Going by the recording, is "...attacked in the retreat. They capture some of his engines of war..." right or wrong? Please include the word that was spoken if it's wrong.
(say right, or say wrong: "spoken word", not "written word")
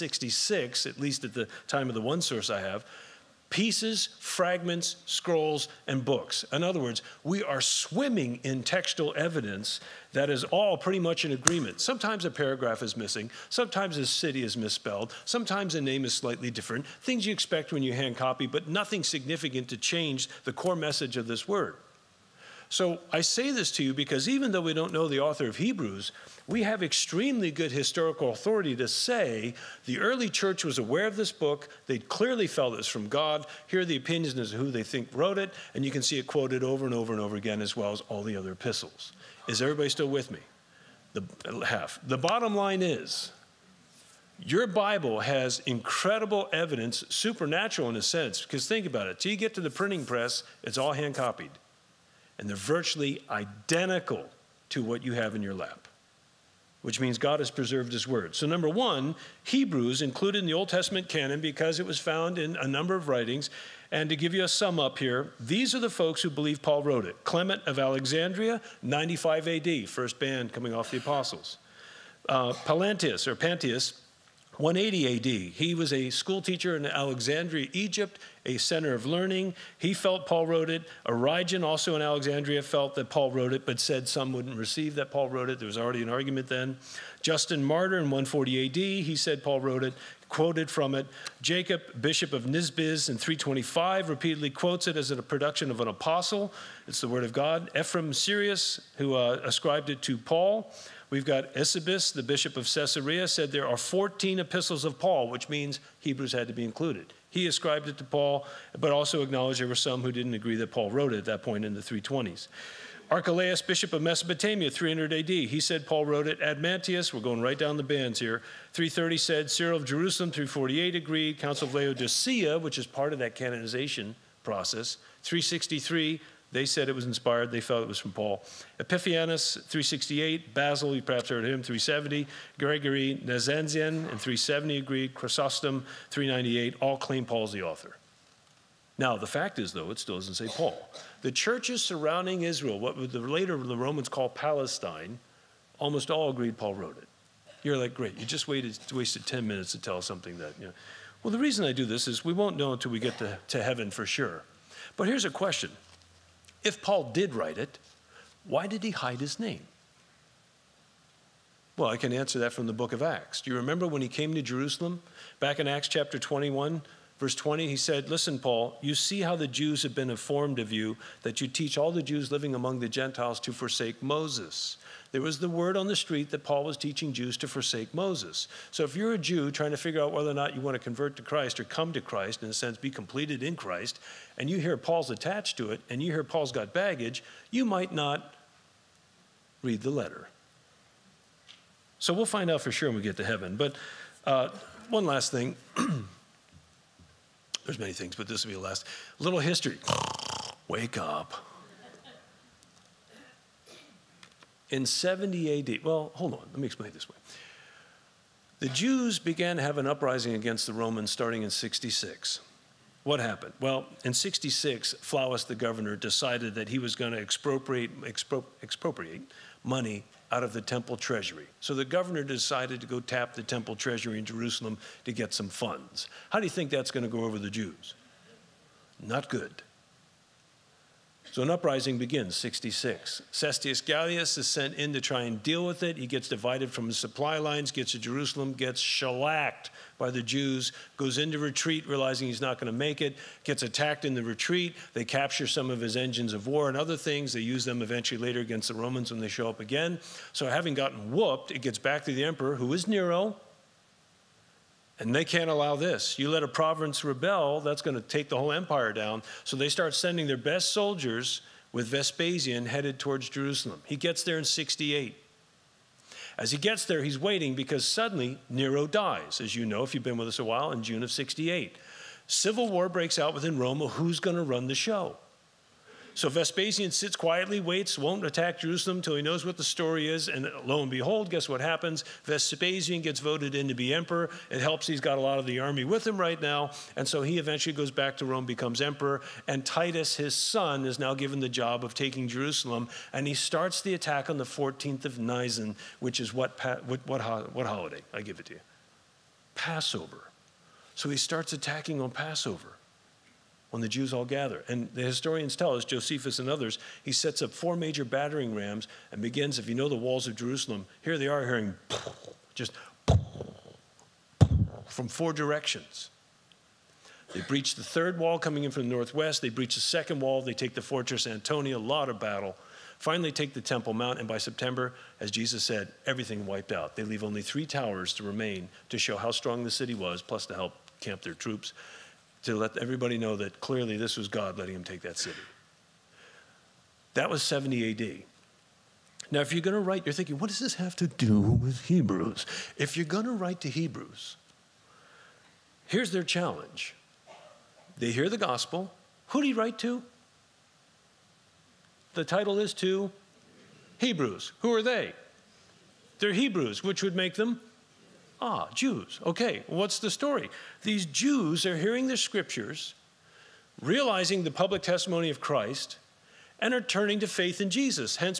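right.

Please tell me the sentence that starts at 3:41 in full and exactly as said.
So the governor decided to go tap the temple treasury in Jerusalem to get some funds.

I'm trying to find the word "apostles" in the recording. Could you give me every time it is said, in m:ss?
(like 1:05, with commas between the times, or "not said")
1:10, 1:35.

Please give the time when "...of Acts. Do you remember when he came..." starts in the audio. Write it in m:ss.
2:42.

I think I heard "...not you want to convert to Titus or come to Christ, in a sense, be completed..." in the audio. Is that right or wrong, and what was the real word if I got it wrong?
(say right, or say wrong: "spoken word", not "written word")
wrong: "Christ", not "Titus".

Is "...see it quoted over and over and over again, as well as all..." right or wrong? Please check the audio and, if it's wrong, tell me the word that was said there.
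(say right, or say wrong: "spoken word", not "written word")
right.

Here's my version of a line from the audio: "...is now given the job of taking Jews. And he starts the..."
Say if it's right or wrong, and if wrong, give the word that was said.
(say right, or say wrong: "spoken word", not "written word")
wrong: "Jerusalem", not "Jews".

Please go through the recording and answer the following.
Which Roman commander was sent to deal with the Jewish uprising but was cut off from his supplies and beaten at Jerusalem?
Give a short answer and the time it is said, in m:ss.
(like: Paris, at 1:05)
Cestius Gallius, at 3:53.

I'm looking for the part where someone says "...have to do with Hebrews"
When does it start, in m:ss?
5:40.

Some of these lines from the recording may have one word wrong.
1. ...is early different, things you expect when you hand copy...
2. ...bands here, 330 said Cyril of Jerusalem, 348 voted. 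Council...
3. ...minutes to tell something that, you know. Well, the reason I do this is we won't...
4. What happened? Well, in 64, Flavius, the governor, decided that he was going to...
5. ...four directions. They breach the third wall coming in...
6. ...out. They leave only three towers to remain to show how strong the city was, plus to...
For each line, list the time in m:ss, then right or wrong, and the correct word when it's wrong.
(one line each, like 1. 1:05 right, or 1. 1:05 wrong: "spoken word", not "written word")
1. 0:16 wrong: "slightly", not "early"
2. 1:57 wrong: "agreed", not "voted"
3. 2:29 right
4. 3:33 wrong: "66", not "64"
5. 5:15 right
6. 5:26 right.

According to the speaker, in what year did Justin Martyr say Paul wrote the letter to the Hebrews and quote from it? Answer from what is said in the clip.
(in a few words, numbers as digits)
140 AD.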